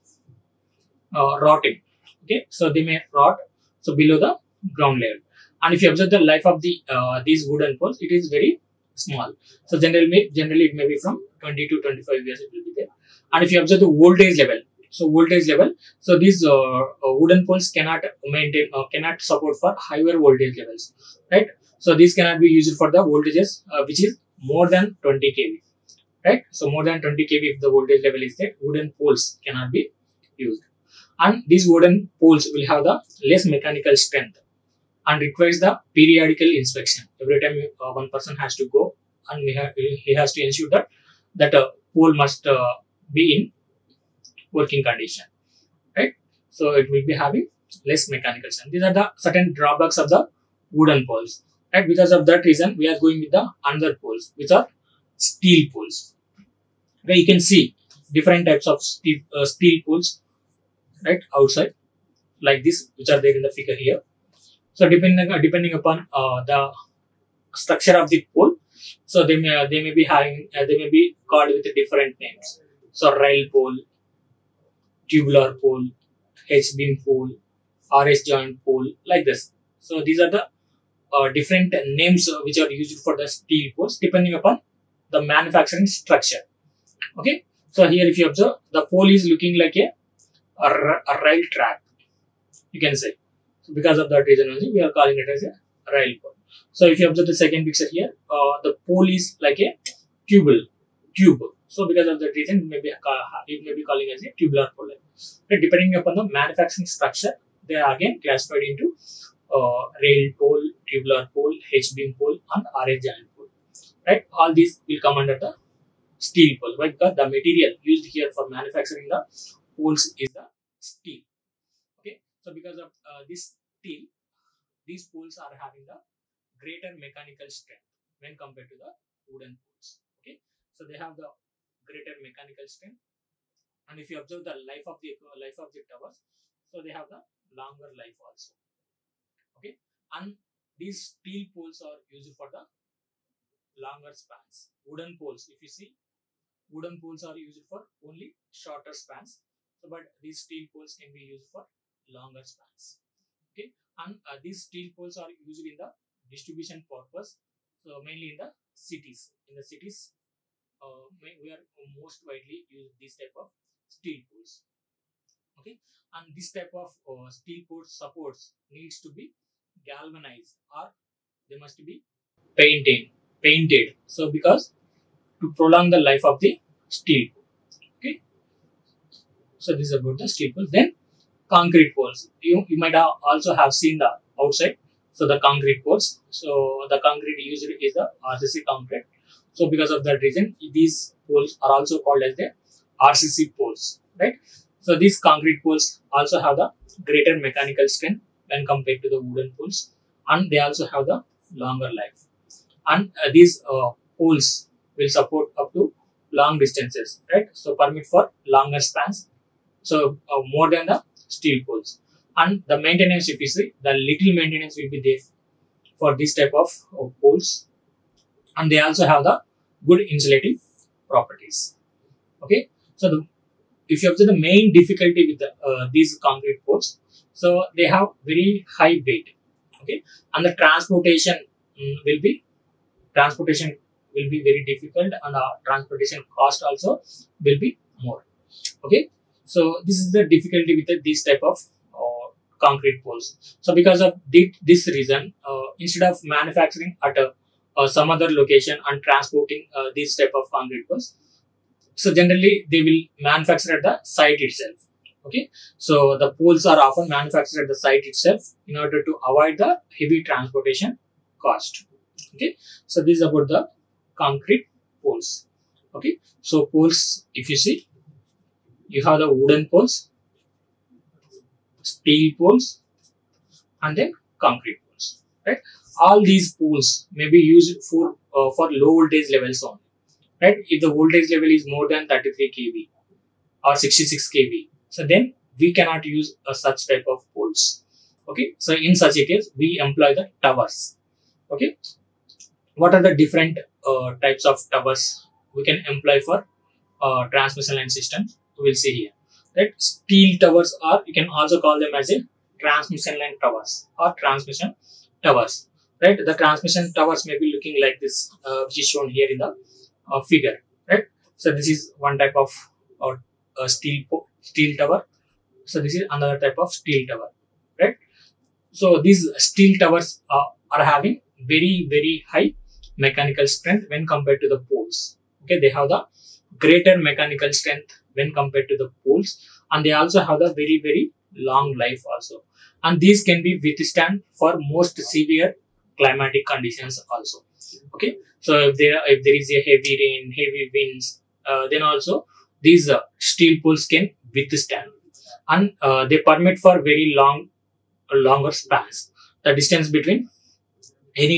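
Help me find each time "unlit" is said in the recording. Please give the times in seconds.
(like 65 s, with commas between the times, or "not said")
not said.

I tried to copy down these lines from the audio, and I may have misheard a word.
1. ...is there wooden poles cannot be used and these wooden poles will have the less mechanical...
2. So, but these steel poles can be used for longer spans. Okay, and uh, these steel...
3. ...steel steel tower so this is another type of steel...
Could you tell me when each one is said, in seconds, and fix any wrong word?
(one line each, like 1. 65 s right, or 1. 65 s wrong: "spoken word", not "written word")
1. 28 s right
2. 149 s right
3. 313 s right.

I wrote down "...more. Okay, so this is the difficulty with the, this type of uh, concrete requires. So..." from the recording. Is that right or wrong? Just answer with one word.
wrong.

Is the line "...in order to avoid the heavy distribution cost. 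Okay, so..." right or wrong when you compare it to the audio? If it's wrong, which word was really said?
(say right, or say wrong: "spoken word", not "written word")
wrong: "transportation", not "distribution".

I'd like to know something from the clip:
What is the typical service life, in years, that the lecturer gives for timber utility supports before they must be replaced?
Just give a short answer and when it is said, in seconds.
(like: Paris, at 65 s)
20 to 25 years, at 11 s.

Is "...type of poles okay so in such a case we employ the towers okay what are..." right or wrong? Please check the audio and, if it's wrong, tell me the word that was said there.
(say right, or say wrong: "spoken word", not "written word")
right.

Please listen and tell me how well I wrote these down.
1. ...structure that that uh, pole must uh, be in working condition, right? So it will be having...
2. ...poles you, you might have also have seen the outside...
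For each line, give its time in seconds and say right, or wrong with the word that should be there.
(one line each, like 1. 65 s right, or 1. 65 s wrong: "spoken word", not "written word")
1. 40 s wrong: "ensure", not "structure"
2. 181 s right.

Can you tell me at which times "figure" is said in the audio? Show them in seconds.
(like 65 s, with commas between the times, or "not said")
63 s, 310 s.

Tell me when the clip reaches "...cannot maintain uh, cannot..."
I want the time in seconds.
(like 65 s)
17 s.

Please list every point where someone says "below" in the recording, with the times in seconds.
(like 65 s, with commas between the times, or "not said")
4 s.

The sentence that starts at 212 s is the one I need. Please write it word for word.
And the maintenance efficiency, the little maintenance will be there for this type of uh, poles.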